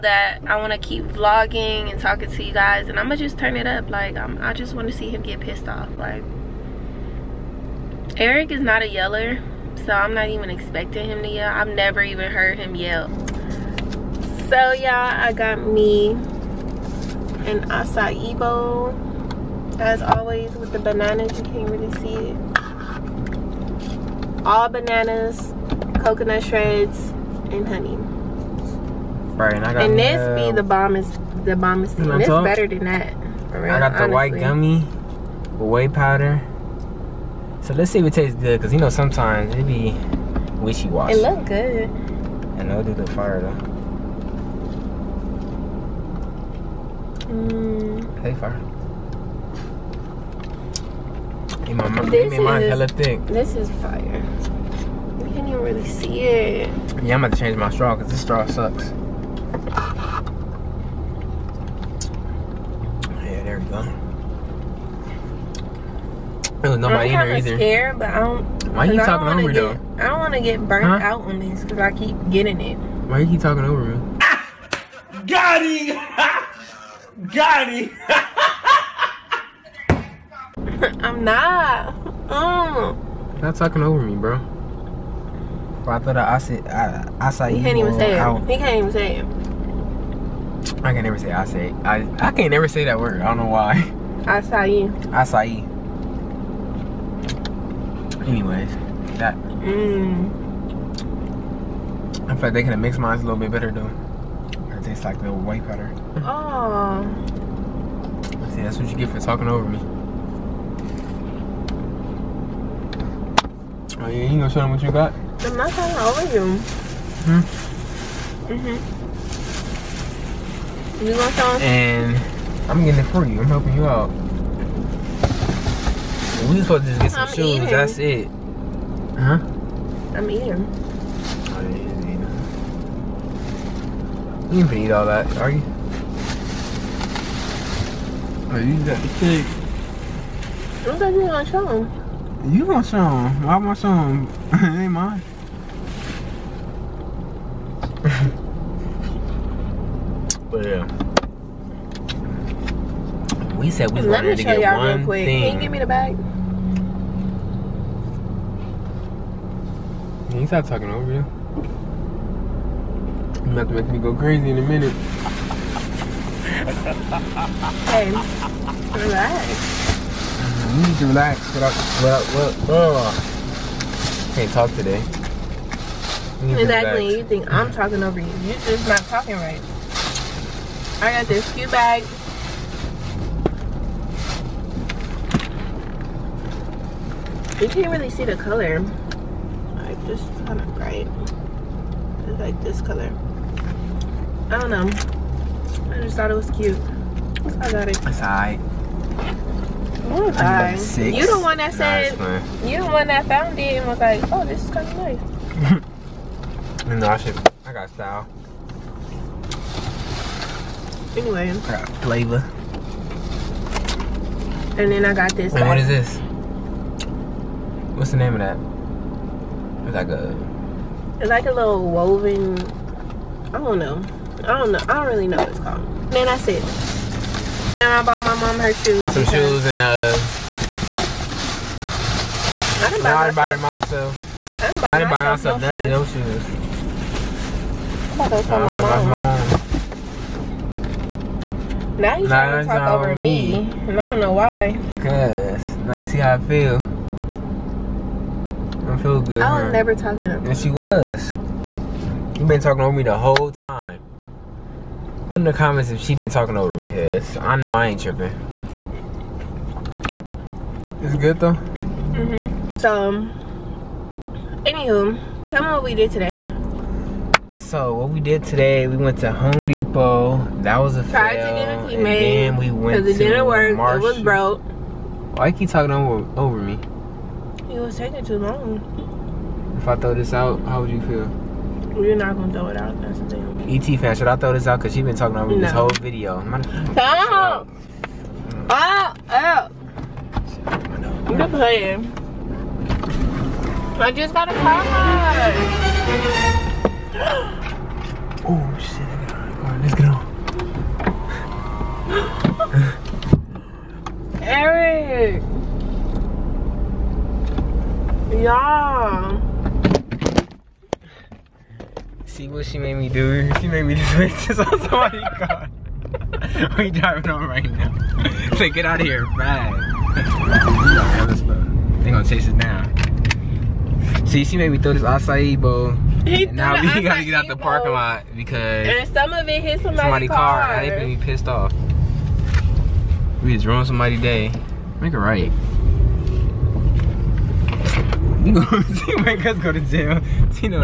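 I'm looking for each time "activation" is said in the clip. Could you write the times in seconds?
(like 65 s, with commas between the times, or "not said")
not said.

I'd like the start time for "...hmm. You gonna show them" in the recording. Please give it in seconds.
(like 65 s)
118 s.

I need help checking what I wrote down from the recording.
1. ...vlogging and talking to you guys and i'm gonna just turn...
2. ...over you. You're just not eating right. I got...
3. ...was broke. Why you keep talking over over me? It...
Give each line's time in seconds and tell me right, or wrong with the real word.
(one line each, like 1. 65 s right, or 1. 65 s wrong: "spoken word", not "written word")
1. 1 s right
2. 178 s wrong: "talking", not "eating"
3. 274 s right.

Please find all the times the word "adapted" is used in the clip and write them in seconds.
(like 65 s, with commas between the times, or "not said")
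not said.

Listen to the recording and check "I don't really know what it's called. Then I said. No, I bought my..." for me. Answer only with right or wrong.
right.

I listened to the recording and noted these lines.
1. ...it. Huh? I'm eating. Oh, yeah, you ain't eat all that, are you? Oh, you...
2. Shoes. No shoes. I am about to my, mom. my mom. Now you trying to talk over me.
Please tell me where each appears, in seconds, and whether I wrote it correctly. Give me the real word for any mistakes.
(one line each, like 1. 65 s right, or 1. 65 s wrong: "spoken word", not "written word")
1. 127 s right
2. 236 s right.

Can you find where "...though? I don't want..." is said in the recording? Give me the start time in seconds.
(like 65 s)
69 s.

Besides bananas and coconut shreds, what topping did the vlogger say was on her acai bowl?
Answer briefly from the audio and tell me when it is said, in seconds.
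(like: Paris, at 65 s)
honey, at 27 s.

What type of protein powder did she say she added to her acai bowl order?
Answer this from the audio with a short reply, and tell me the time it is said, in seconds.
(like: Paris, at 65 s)
whey powder, at 35 s.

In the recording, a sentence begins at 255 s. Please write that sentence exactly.
Put in the comments if she been talking over me, cause I know I ain't tripping.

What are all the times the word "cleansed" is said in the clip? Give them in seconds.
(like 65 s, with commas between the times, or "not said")
not said.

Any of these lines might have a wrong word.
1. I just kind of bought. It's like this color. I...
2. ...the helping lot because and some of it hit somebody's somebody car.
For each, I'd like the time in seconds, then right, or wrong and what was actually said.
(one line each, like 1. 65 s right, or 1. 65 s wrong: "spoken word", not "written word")
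1. 189 s wrong: "bright", not "bought"
2. 327 s wrong: "parking", not "helping".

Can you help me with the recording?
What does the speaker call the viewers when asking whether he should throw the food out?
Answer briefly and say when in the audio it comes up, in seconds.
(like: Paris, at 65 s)
ET fam, at 283 s.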